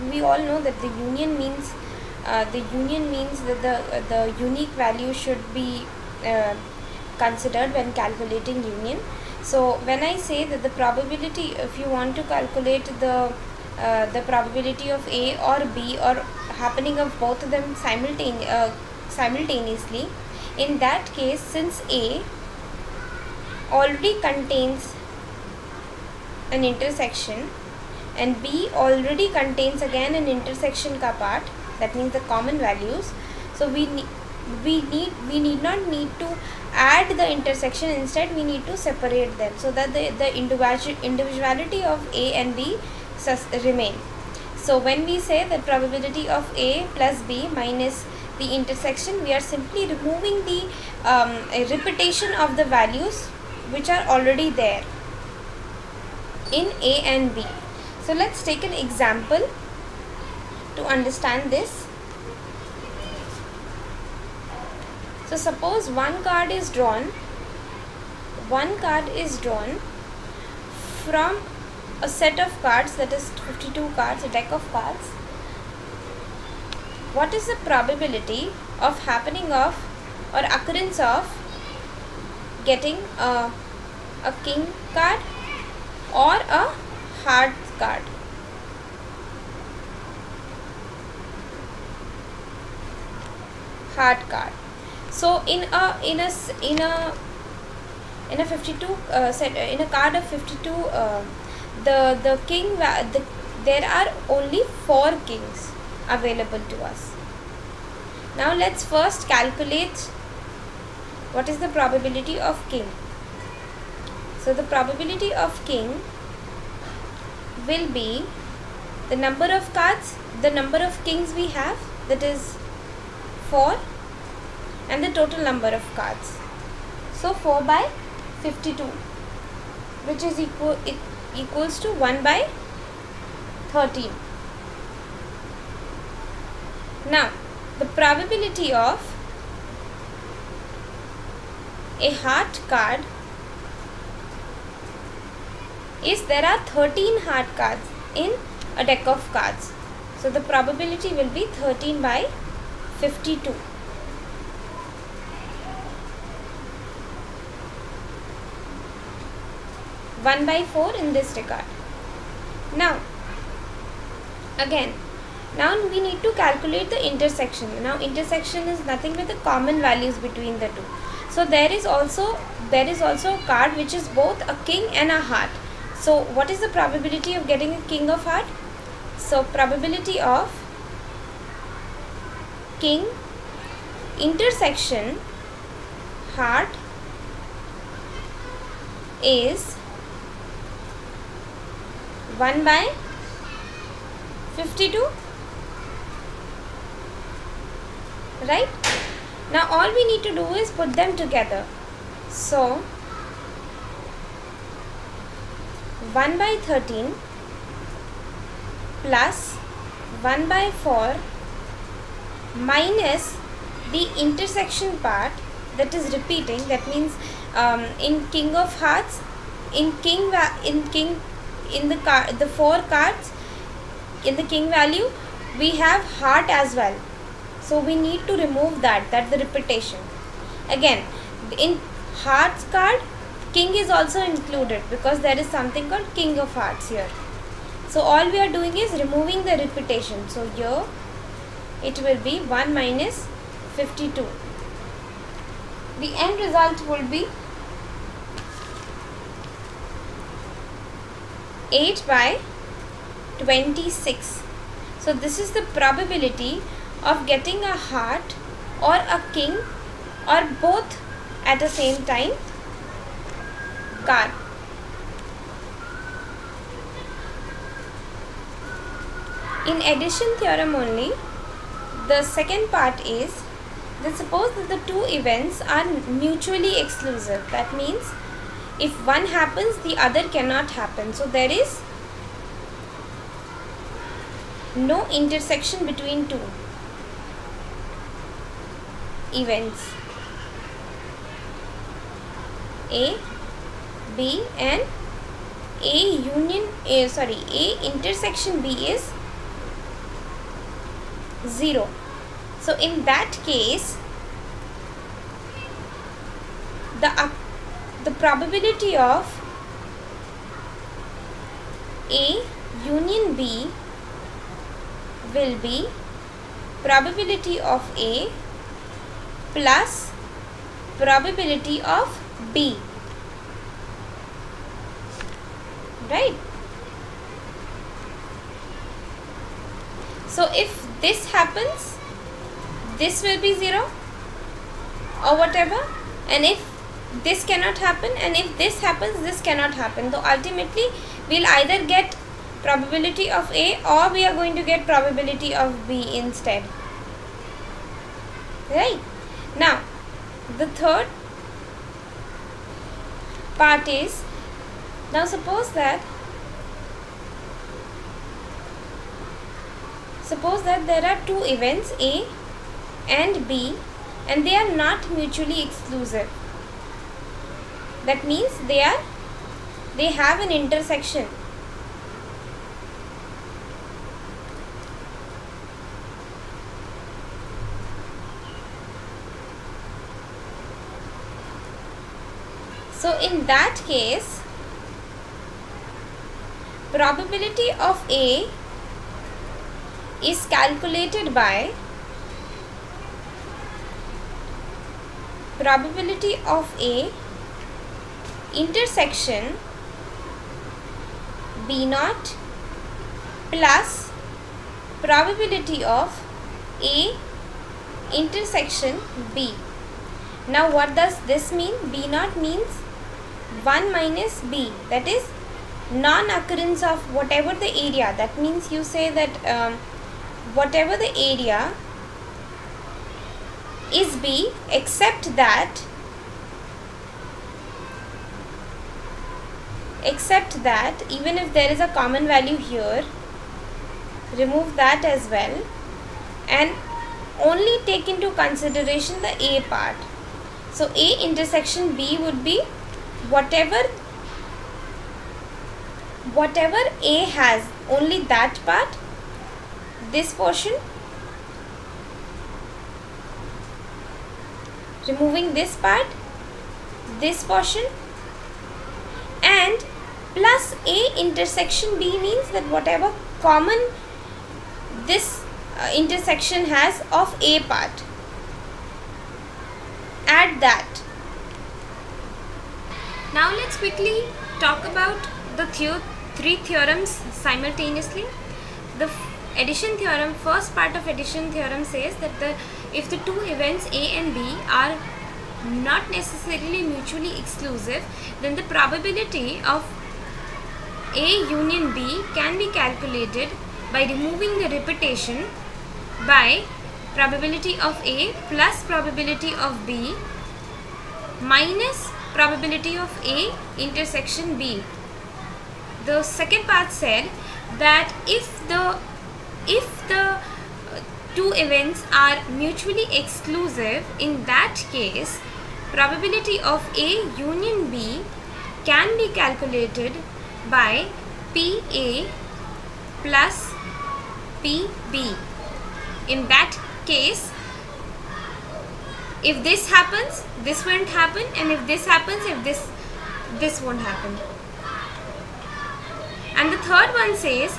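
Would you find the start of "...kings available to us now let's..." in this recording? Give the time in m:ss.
1:45.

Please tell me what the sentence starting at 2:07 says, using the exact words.
So 4 by 52 which is equal it equals to 1 by 13.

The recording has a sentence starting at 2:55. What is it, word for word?
So, what is the probability of getting a king of heart?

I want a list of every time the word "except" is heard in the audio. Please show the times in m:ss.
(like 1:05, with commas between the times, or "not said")
7:04, 7:10.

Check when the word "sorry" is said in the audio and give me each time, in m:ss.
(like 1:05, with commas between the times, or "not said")
4:57.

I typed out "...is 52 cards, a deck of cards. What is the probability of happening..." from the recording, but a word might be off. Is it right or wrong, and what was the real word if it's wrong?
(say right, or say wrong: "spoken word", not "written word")
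right.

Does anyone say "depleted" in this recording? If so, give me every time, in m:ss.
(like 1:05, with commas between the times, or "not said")
not said.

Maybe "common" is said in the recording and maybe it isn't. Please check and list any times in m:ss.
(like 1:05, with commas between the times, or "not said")
0:32, 2:49, 7:11, 7:43.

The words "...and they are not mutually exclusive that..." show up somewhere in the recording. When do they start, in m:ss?
6:04.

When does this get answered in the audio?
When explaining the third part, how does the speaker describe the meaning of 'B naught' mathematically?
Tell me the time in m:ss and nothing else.
6:53.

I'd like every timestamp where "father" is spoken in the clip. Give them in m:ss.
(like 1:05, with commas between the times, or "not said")
not said.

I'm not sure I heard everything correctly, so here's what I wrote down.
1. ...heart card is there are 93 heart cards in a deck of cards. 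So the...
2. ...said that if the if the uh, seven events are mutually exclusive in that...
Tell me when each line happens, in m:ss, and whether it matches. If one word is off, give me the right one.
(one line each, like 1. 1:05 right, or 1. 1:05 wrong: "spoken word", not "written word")
1. 2:22 wrong: "13", not "93"
2. 8:26 wrong: "two", not "seven".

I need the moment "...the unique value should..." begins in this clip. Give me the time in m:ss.
0:04.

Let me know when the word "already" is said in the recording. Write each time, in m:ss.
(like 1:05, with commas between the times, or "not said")
0:23, 0:28, 0:54.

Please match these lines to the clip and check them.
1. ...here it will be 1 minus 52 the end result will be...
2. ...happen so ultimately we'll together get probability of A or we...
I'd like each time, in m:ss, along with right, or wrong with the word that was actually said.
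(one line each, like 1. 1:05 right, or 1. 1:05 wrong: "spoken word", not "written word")
1. 4:00 right
2. 5:39 wrong: "either", not "together".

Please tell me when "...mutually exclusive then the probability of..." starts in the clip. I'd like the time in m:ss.
8:06.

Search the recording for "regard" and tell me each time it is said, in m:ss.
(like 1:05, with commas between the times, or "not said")
2:41.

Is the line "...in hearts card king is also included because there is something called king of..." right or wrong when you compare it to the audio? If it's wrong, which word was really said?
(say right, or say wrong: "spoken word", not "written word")
right.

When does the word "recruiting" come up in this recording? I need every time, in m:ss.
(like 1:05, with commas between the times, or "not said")
not said.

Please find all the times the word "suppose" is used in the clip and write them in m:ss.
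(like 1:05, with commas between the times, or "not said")
1:05, 4:34, 5:55, 6:00.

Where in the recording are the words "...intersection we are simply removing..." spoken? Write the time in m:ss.
0:48.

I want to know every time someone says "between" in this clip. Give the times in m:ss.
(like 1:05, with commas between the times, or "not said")
2:50, 4:45.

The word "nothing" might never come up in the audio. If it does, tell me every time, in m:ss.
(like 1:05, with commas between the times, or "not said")
2:48.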